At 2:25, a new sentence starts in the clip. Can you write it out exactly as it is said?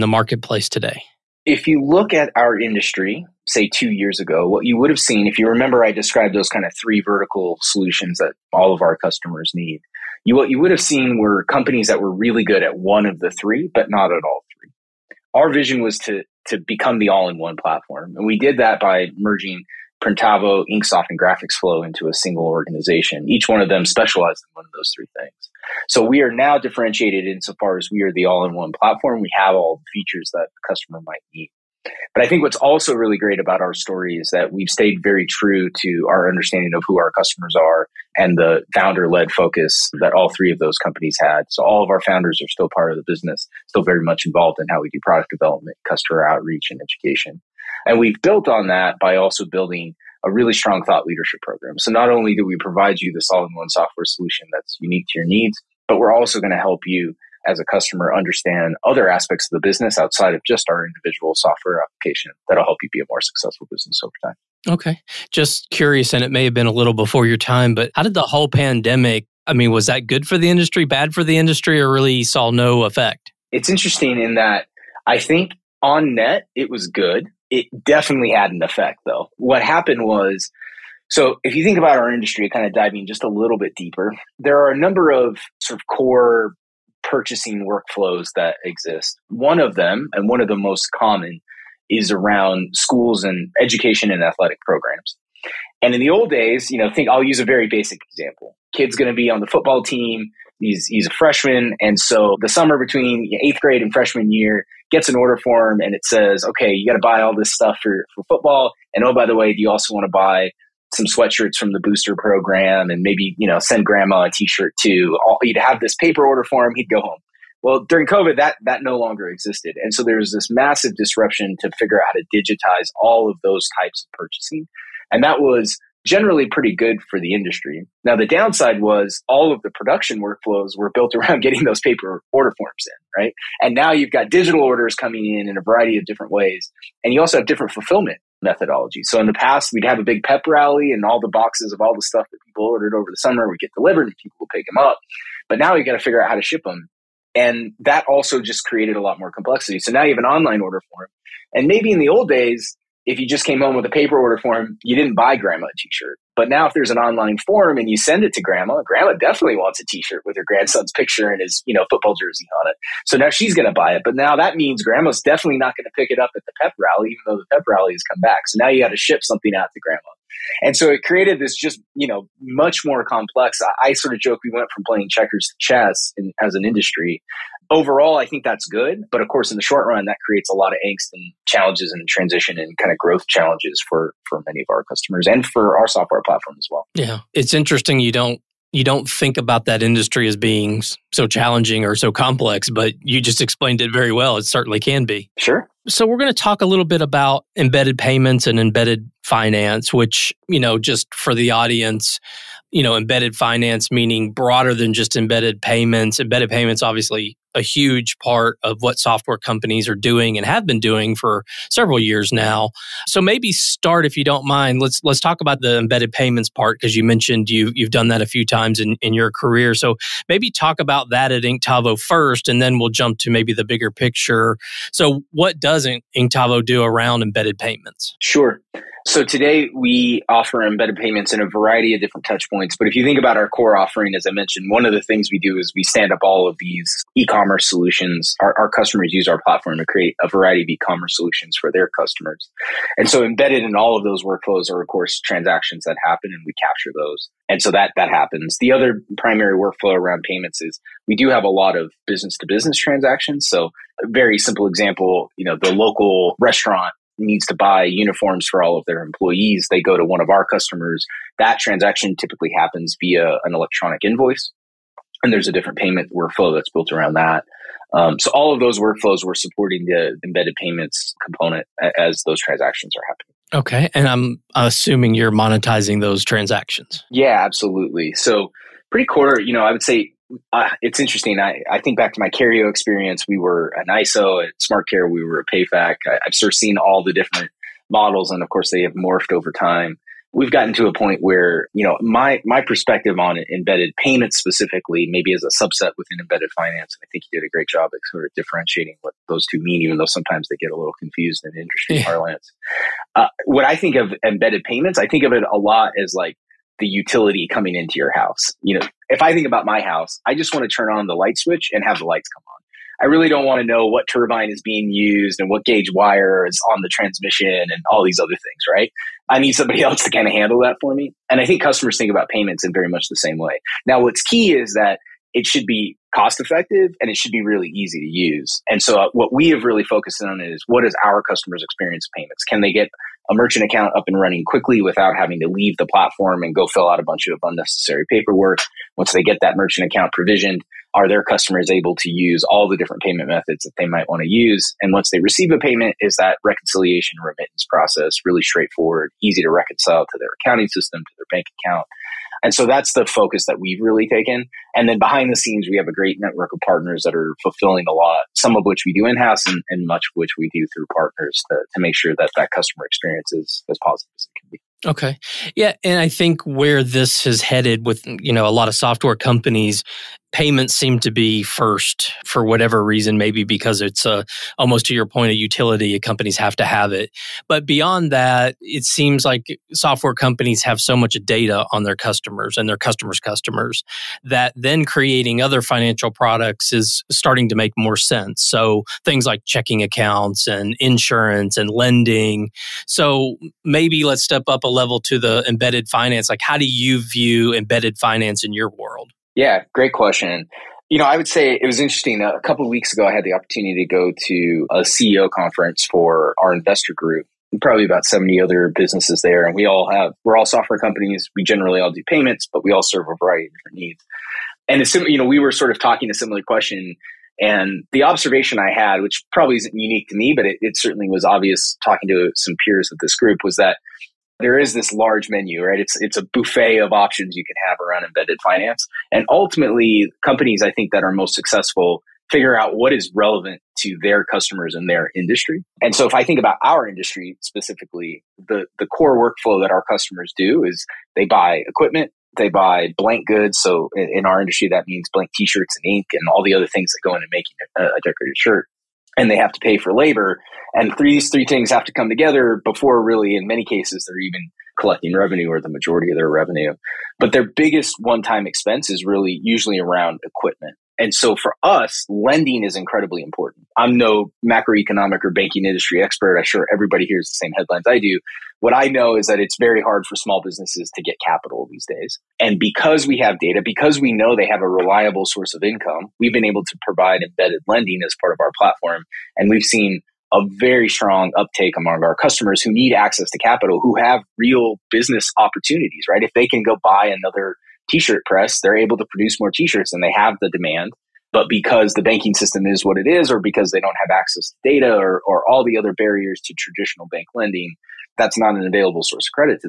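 But now you've got to figure out how to ship them.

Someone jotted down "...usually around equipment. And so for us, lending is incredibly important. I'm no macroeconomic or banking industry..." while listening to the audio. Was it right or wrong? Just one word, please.
right.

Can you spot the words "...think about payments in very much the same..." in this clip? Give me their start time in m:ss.
5:21.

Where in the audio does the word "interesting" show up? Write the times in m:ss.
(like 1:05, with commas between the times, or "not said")
1:13, 3:07, 4:40, 6:41.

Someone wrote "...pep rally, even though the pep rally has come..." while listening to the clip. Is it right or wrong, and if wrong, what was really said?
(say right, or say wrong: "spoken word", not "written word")
right.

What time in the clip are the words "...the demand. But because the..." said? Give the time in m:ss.
8:10.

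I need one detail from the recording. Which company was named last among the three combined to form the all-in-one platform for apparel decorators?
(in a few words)
Graphics Flow.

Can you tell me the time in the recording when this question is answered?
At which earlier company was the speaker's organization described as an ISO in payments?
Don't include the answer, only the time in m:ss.
4:42.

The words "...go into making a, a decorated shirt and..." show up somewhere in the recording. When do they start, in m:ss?
7:27.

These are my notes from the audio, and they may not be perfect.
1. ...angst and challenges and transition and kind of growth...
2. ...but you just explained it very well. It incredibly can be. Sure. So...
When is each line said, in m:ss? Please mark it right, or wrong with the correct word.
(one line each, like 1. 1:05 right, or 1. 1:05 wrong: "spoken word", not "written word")
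1. 3:00 right
2. 3:12 wrong: "certainly", not "incredibly".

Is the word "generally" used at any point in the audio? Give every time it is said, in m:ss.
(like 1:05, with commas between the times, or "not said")
2:06, 6:51.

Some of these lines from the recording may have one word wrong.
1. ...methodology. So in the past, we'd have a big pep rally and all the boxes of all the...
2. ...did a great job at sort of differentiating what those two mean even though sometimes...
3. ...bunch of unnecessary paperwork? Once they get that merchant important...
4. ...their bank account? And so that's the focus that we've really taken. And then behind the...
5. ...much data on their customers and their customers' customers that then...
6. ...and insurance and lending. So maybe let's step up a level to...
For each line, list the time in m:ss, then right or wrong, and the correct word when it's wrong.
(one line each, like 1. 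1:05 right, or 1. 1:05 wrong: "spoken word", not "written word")
1. 2:18 right
2. 4:57 right
3. 5:37 wrong: "account", not "important"
4. 5:51 right
5. 6:20 right
6. 6:30 right.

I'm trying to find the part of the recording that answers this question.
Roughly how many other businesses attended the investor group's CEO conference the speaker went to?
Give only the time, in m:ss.
6:48.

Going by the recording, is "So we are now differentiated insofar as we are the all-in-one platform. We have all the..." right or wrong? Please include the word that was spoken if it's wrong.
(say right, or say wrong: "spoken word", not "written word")
right.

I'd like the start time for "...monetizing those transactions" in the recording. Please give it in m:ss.
4:35.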